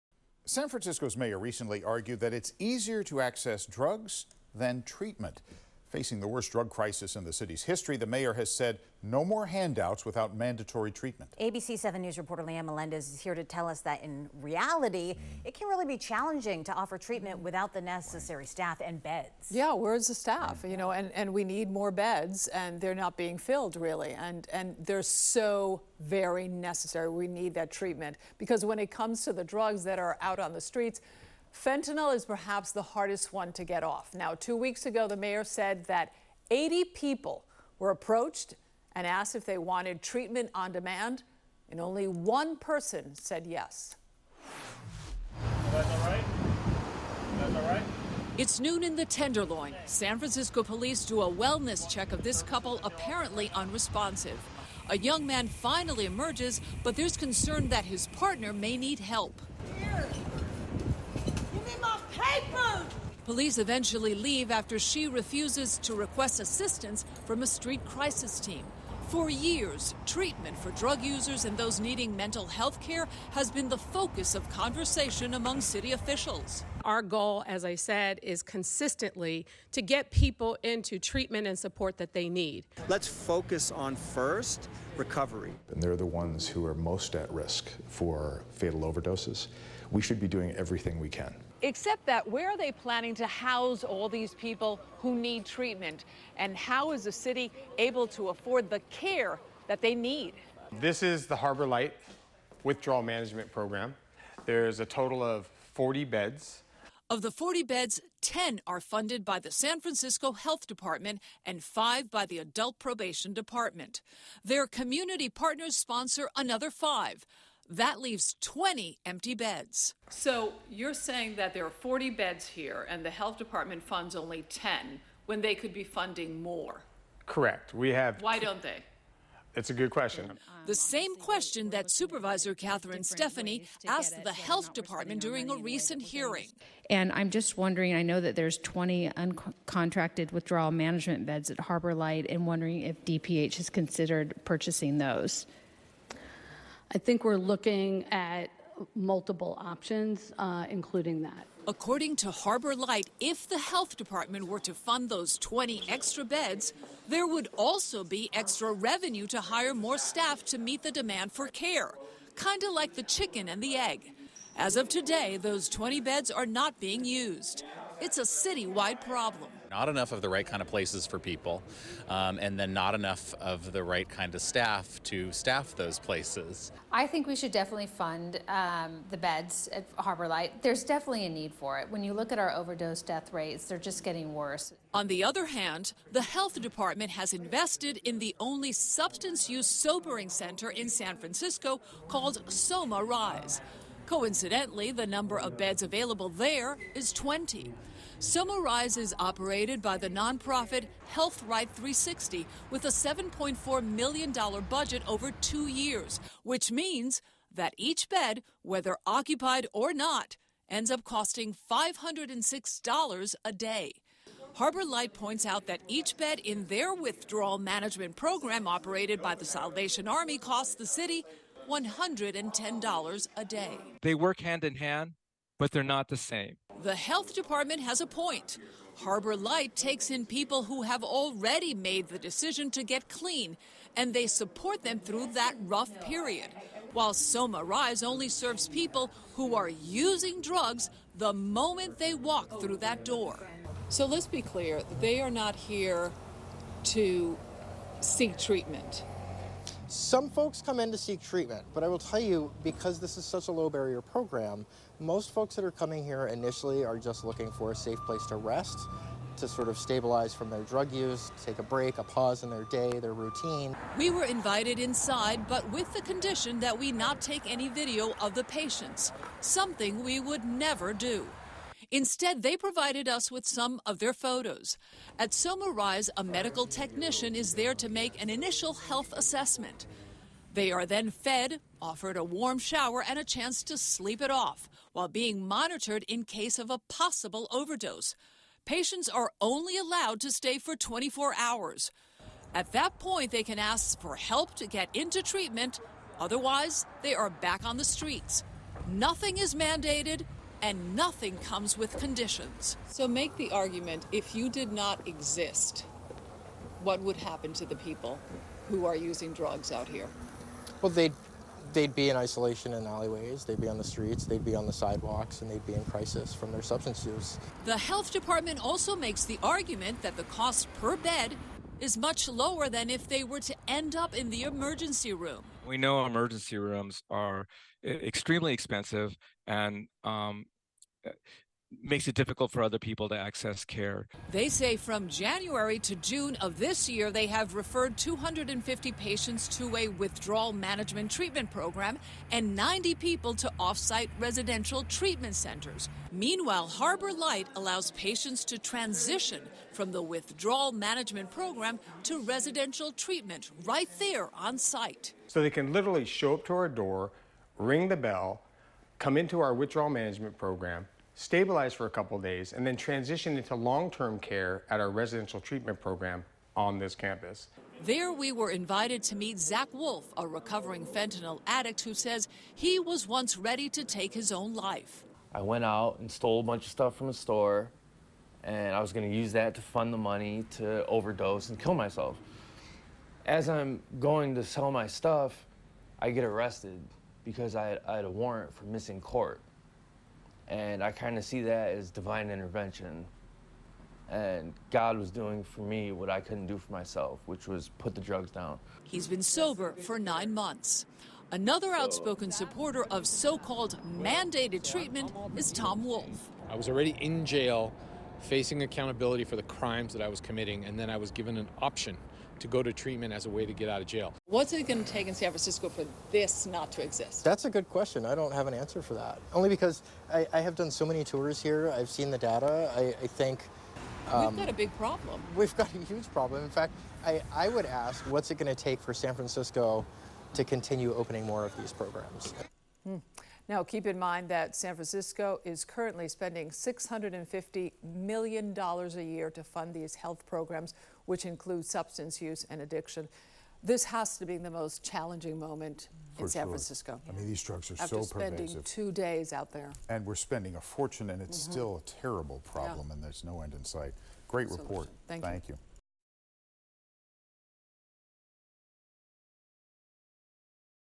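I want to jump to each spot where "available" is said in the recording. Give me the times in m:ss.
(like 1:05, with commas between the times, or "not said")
3:15.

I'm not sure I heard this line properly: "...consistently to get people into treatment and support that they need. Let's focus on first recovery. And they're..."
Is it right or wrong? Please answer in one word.
right.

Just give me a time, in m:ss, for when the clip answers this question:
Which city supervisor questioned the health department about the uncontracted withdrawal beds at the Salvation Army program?
2:12.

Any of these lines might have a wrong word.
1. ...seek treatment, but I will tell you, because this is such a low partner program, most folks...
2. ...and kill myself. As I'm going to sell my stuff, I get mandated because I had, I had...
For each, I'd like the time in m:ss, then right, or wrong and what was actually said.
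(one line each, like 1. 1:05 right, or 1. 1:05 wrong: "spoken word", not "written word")
1. 4:10 wrong: "barrier", not "partner"
2. 6:21 wrong: "arrested", not "mandated".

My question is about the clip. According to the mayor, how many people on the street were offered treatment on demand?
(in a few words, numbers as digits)
80.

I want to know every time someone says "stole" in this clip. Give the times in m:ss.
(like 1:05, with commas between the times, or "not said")
6:16.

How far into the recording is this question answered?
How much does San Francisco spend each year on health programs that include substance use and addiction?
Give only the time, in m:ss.
7:16.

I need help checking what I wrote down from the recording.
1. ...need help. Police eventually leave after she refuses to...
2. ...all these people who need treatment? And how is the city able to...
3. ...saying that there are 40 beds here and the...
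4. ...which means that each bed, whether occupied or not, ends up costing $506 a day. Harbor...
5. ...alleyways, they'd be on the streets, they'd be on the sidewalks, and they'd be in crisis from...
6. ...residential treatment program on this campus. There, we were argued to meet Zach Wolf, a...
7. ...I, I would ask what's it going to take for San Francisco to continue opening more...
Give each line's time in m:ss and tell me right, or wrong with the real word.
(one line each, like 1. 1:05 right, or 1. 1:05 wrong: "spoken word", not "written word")
1. 0:58 right
2. 1:33 right
3. 2:00 right
4. 3:26 right
5. 5:12 right
6. 6:04 wrong: "invited", not "argued"
7. 7:07 right.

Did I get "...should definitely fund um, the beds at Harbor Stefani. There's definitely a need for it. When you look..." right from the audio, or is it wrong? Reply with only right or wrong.
wrong.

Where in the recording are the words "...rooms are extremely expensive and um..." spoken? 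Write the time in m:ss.
5:26.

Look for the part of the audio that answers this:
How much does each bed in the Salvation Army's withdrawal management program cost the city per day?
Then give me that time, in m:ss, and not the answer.
3:41.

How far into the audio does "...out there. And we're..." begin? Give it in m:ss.
7:29.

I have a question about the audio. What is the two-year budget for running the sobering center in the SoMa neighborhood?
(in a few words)
$7.4 million.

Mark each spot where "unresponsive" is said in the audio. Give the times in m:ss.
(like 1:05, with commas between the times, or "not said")
0:53.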